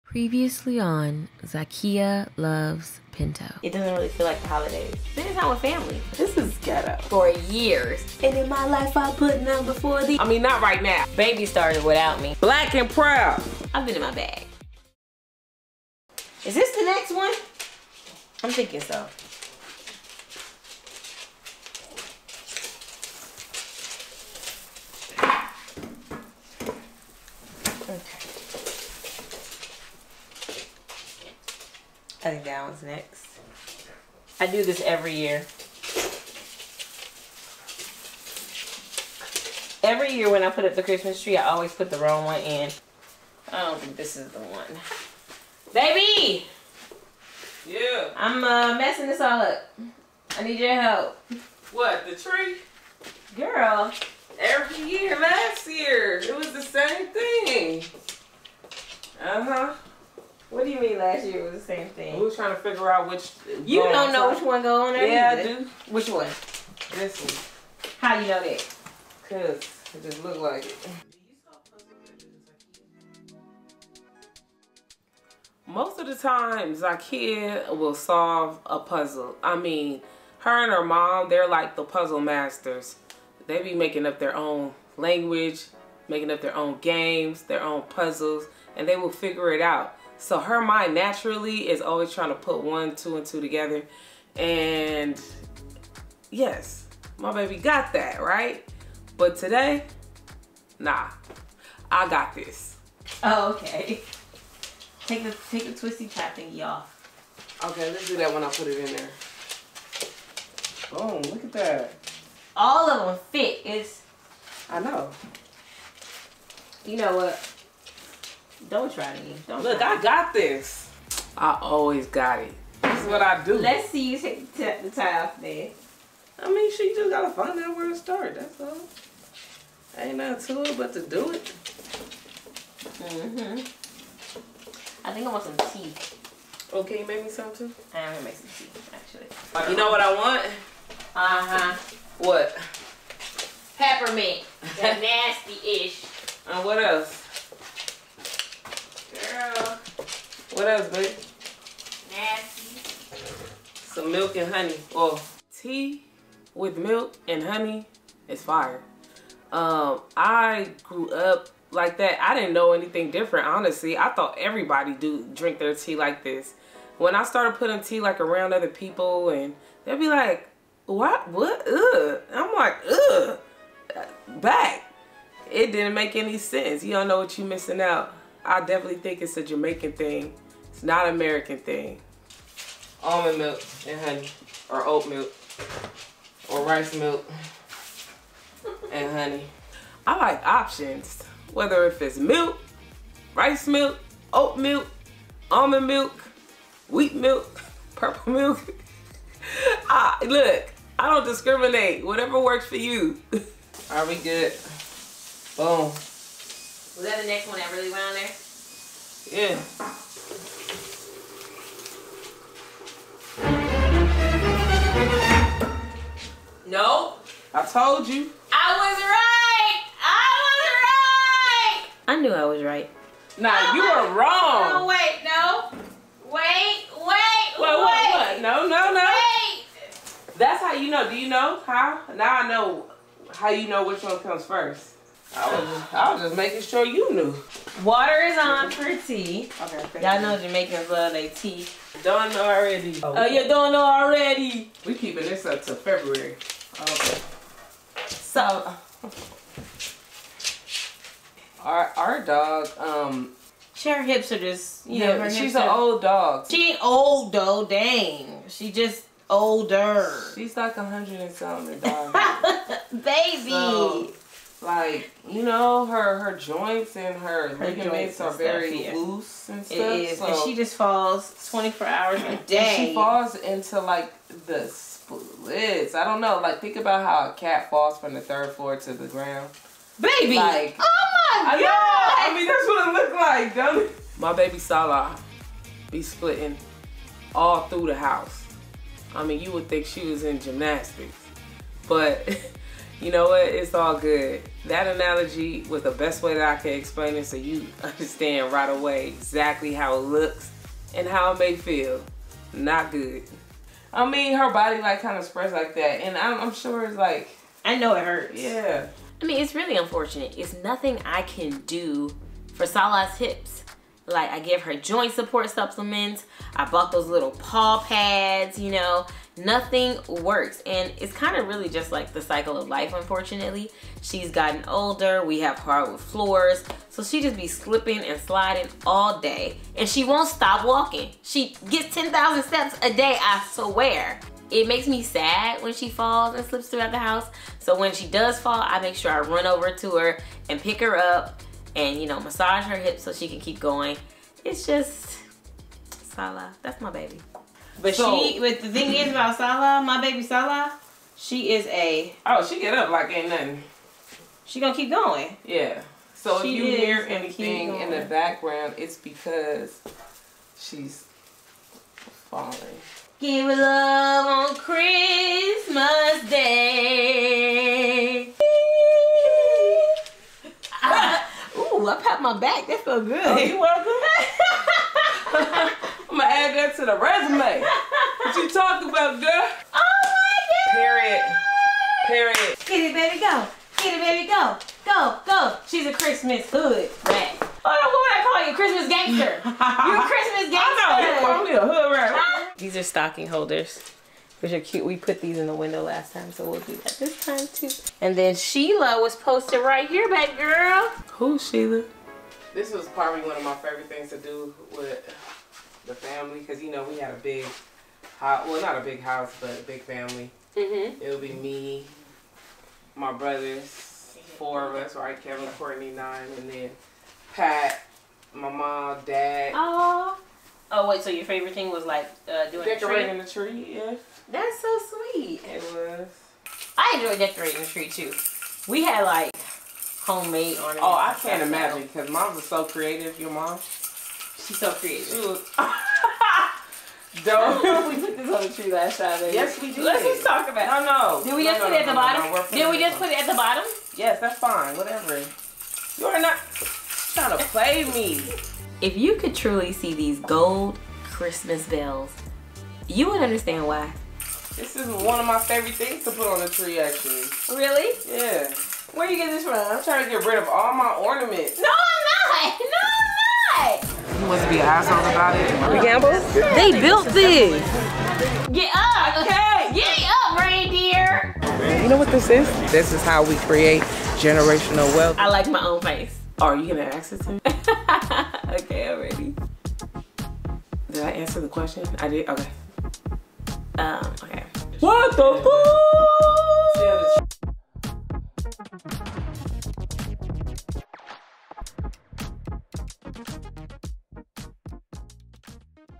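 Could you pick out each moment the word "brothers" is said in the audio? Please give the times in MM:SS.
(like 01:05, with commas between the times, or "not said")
06:53.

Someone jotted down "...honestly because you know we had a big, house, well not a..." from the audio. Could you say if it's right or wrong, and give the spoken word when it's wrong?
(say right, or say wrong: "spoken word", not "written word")
wrong: "family", not "honestly".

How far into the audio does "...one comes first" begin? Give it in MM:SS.
03:54.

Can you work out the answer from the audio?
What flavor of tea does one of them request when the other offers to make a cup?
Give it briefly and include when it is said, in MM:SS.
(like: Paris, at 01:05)
Peppermint, at 02:23.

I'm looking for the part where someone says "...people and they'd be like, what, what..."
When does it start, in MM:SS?
02:48.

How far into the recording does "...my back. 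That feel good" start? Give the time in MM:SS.
06:12.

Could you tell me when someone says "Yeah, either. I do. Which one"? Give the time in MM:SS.
01:05.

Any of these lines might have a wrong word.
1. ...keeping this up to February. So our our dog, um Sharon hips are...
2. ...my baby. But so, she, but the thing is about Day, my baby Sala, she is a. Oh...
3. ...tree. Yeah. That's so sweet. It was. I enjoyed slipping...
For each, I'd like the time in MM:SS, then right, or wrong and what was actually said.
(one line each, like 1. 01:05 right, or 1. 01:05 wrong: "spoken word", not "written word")
1. 04:04 right
2. 05:46 wrong: "Sala", not "Day"
3. 07:03 wrong: "decorating", not "slipping".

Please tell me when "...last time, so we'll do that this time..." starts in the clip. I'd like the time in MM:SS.
06:35.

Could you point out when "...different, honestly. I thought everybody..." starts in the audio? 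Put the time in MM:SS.
02:43.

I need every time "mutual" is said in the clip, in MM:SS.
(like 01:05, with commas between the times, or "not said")
not said.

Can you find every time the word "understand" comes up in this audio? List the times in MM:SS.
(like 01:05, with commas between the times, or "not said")
04:57, 07:33.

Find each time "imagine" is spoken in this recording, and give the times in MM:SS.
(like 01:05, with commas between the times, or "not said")
07:11.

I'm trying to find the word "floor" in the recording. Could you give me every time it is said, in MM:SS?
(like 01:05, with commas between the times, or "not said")
04:38, 05:25.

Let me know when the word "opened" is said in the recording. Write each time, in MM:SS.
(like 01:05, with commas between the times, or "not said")
not said.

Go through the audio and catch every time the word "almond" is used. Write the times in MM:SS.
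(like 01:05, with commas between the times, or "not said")
03:03, 03:15.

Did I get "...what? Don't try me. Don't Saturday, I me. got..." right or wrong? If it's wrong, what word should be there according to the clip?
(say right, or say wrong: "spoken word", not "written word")
wrong: "Look", not "Saturday".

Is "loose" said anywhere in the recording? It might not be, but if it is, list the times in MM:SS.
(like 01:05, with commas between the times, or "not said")
04:28.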